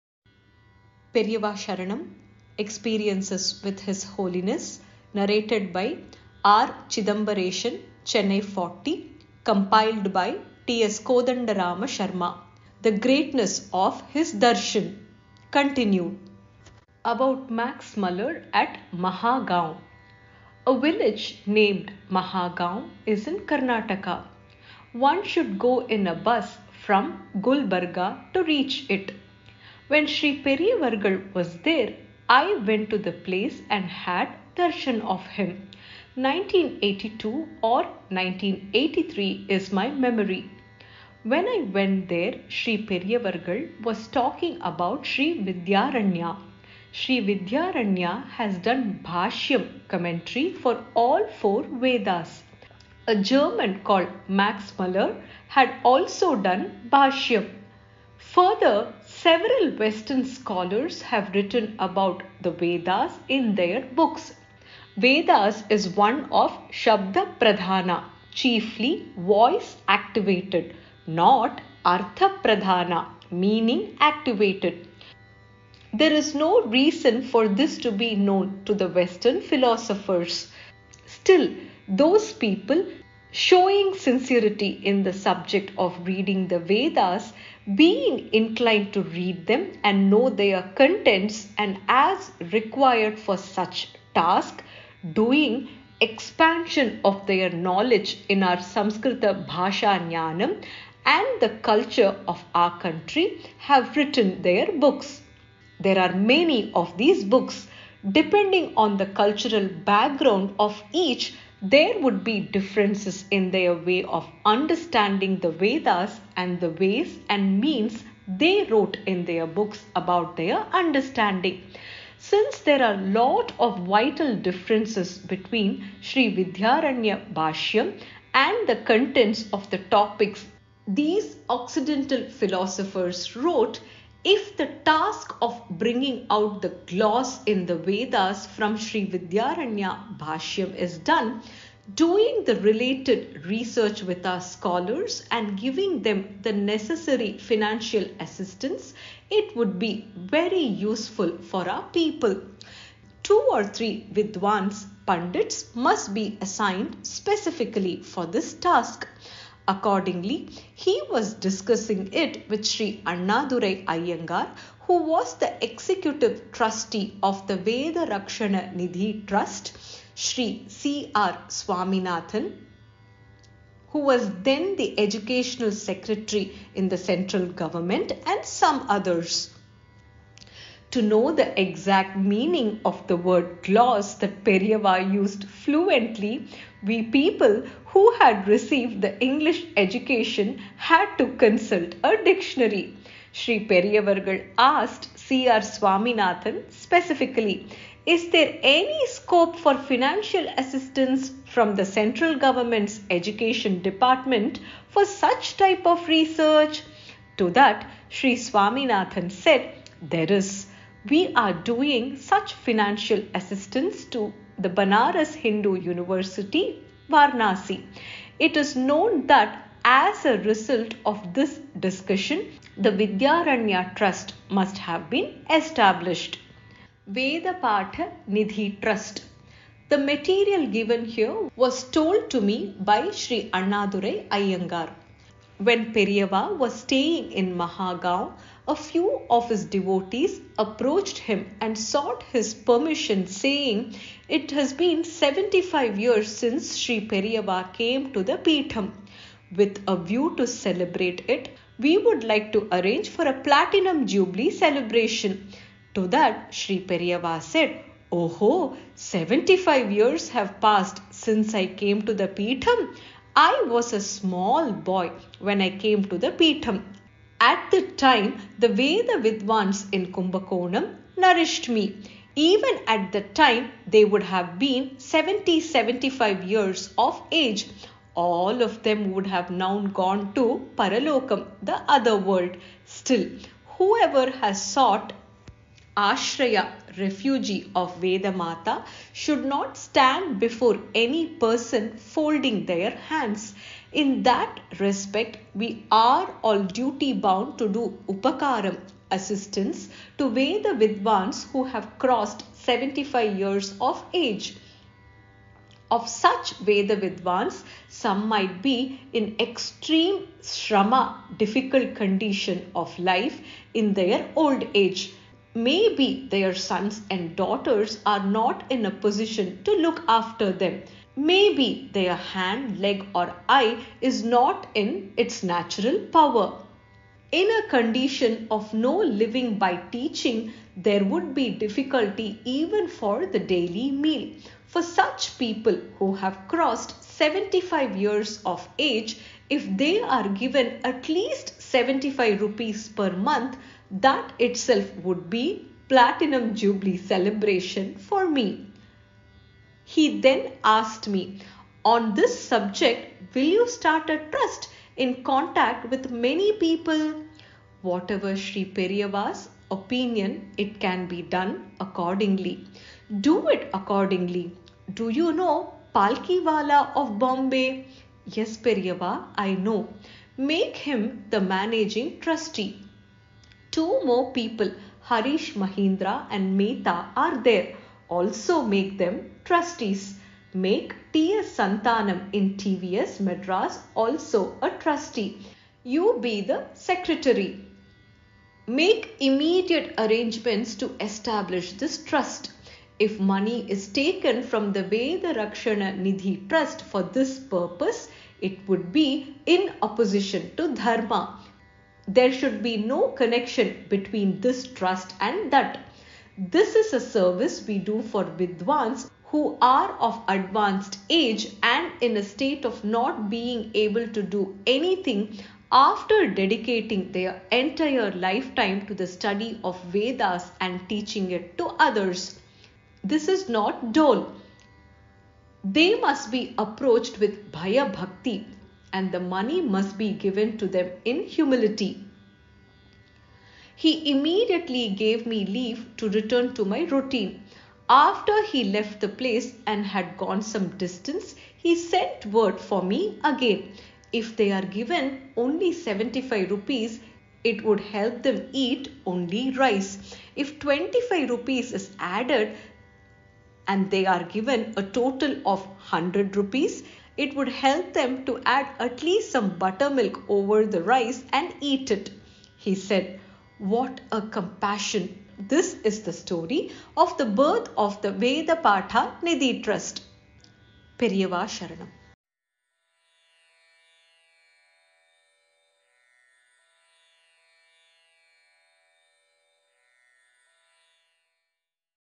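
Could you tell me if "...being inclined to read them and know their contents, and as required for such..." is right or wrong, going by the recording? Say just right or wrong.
right.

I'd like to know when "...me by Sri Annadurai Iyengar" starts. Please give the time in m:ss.
3:52.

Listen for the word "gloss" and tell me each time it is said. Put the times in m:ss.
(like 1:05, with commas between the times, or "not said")
2:16, 3:03.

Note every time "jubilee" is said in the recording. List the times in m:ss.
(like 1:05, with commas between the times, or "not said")
4:14, 5:46.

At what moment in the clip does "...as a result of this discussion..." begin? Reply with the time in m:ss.
3:39.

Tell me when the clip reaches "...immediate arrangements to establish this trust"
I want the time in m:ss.
6:29.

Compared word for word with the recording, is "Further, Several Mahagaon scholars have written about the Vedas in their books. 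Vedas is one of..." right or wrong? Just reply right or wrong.
wrong.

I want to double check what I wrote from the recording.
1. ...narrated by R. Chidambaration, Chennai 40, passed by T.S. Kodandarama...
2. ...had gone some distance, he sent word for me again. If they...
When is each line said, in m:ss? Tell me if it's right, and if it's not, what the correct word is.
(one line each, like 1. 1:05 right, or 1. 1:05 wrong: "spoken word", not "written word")
1. 0:05 wrong: "compiled", not "passed"
2. 7:19 right.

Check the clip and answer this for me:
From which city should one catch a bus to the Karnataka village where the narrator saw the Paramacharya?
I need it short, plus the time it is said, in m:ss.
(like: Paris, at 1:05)
Gulbarga, at 0:27.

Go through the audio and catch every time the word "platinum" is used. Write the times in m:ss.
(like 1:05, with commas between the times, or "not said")
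4:13, 5:45.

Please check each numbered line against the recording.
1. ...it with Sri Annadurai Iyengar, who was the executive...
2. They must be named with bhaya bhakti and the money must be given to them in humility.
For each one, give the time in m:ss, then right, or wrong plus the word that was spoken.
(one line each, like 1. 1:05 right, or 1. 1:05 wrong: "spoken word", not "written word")
1. 2:42 right
2. 7:05 wrong: "approached", not "named".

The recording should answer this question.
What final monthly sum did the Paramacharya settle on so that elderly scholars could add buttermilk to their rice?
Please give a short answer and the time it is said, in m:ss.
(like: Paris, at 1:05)
100 rupees, at 7:35.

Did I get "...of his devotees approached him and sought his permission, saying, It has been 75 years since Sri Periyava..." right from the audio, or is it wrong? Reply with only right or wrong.
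right.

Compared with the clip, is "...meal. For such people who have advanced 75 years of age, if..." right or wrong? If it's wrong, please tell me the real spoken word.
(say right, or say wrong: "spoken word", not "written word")
wrong: "crossed", not "advanced".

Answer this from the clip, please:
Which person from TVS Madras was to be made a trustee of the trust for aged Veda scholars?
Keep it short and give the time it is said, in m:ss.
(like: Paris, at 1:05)
T.S. Santanam, at 6:21.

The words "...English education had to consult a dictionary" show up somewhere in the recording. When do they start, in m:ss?
3:09.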